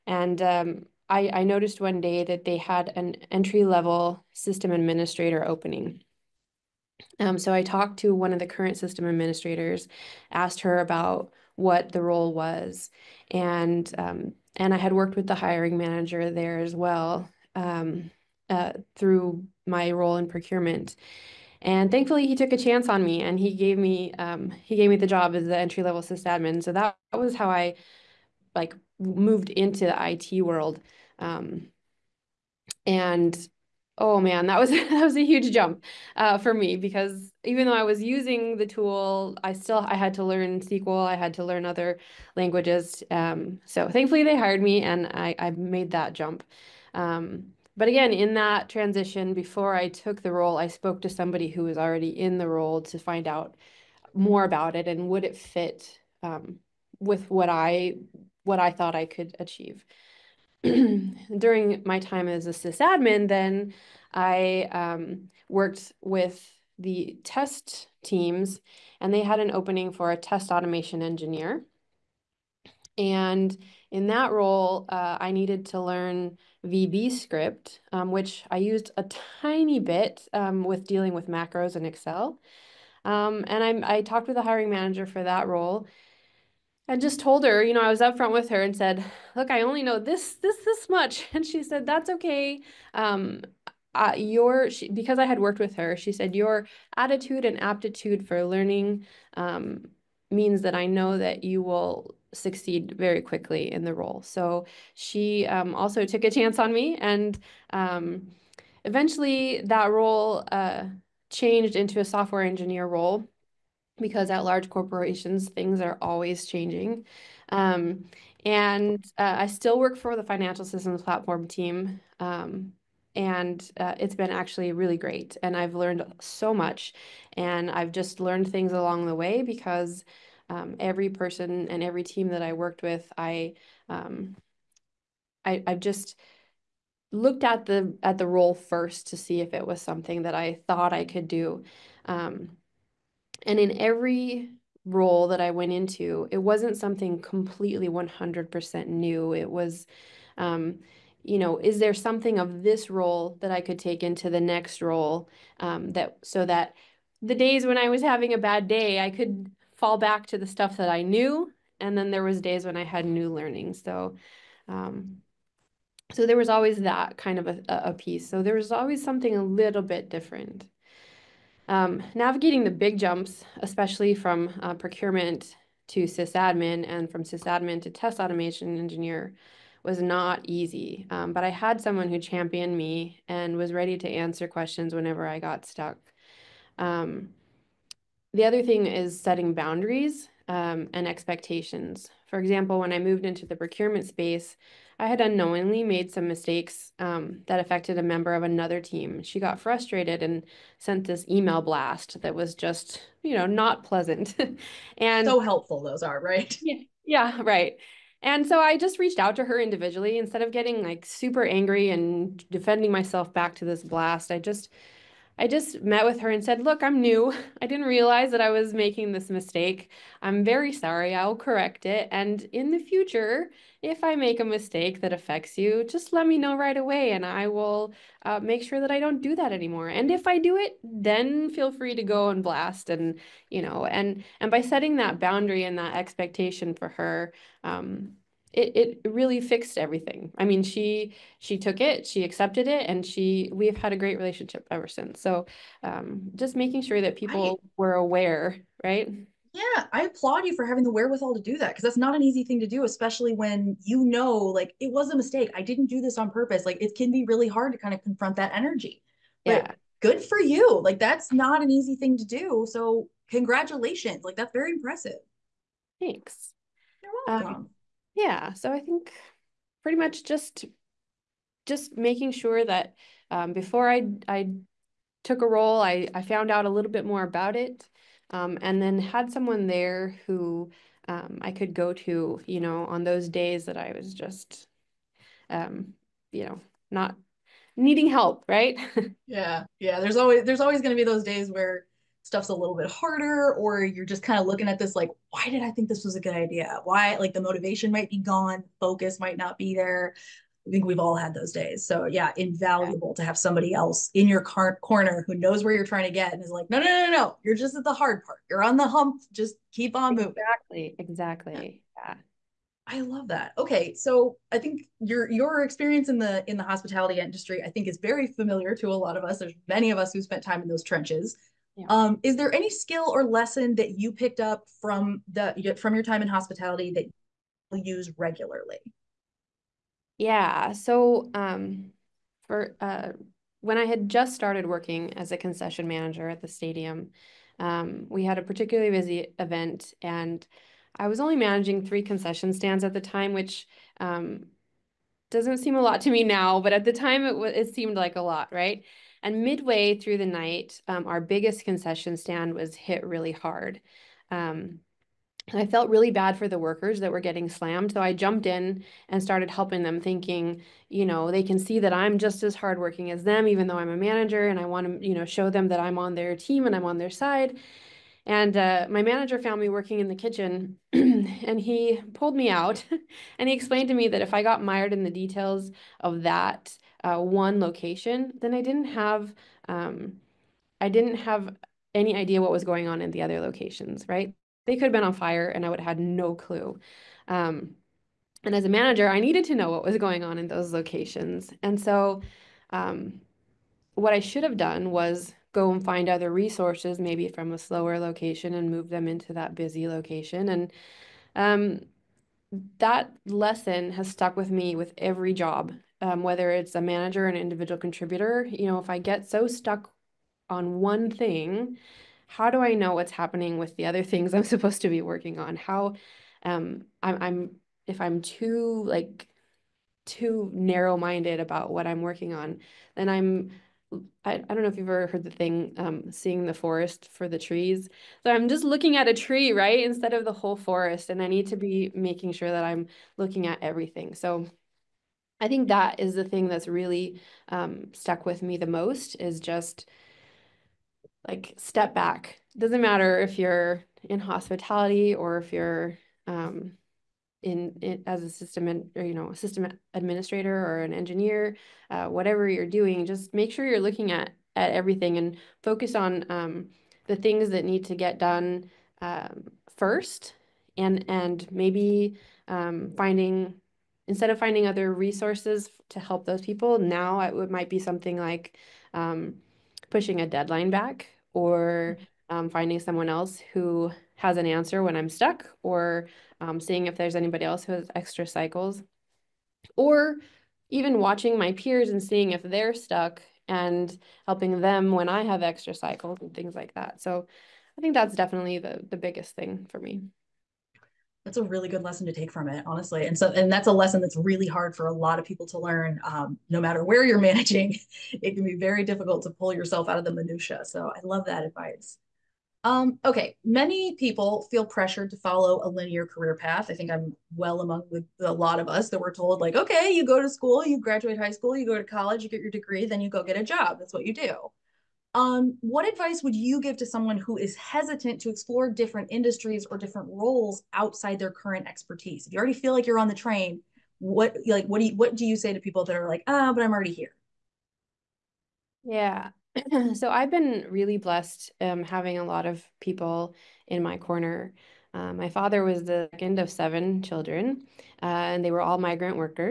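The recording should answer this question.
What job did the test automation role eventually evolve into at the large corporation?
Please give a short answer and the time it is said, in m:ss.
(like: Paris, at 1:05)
software engineer, at 1:52.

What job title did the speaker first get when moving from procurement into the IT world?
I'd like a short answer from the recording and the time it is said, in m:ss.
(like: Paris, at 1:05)
entry level sysadmin, at 0:25.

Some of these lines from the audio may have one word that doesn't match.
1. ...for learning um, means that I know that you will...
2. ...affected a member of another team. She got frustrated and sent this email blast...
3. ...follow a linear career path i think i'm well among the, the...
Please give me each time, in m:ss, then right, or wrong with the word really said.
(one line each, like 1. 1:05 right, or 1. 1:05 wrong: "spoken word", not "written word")
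1. 1:38 right
2. 3:17 right
3. 8:25 right.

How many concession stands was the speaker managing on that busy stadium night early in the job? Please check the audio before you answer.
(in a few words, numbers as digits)
3.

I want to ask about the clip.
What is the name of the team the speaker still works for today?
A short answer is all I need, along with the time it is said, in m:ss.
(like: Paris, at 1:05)
financial systems platform team, at 2:00.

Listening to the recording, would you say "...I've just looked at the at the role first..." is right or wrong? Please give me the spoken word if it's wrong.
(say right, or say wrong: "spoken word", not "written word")
right.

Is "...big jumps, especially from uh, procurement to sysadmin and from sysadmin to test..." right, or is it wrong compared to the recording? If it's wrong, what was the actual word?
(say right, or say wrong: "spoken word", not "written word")
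right.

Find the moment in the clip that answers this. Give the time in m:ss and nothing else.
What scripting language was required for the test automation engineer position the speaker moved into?
1:16.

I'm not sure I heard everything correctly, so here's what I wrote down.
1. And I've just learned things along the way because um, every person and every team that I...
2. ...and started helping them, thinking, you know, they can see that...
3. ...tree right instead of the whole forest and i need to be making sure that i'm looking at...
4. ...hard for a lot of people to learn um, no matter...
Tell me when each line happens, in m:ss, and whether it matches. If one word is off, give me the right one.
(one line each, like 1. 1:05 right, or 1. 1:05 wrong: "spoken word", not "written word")
1. 2:07 right
2. 5:59 right
3. 7:09 right
4. 8:14 right.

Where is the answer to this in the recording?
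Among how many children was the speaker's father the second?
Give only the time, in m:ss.
8:56.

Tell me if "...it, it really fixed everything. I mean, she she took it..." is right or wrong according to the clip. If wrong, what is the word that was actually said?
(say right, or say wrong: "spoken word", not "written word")
right.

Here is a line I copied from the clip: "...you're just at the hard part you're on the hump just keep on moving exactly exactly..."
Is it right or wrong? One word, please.
right.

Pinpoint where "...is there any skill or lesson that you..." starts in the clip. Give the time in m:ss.
5:22.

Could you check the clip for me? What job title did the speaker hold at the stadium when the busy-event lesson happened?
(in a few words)
concession manager.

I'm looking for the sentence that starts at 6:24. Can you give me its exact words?
They could have been on fire and I would have had no clue.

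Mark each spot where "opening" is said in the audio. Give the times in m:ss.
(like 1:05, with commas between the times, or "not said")
0:05, 1:09.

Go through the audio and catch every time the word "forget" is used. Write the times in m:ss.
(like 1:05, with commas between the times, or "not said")
not said.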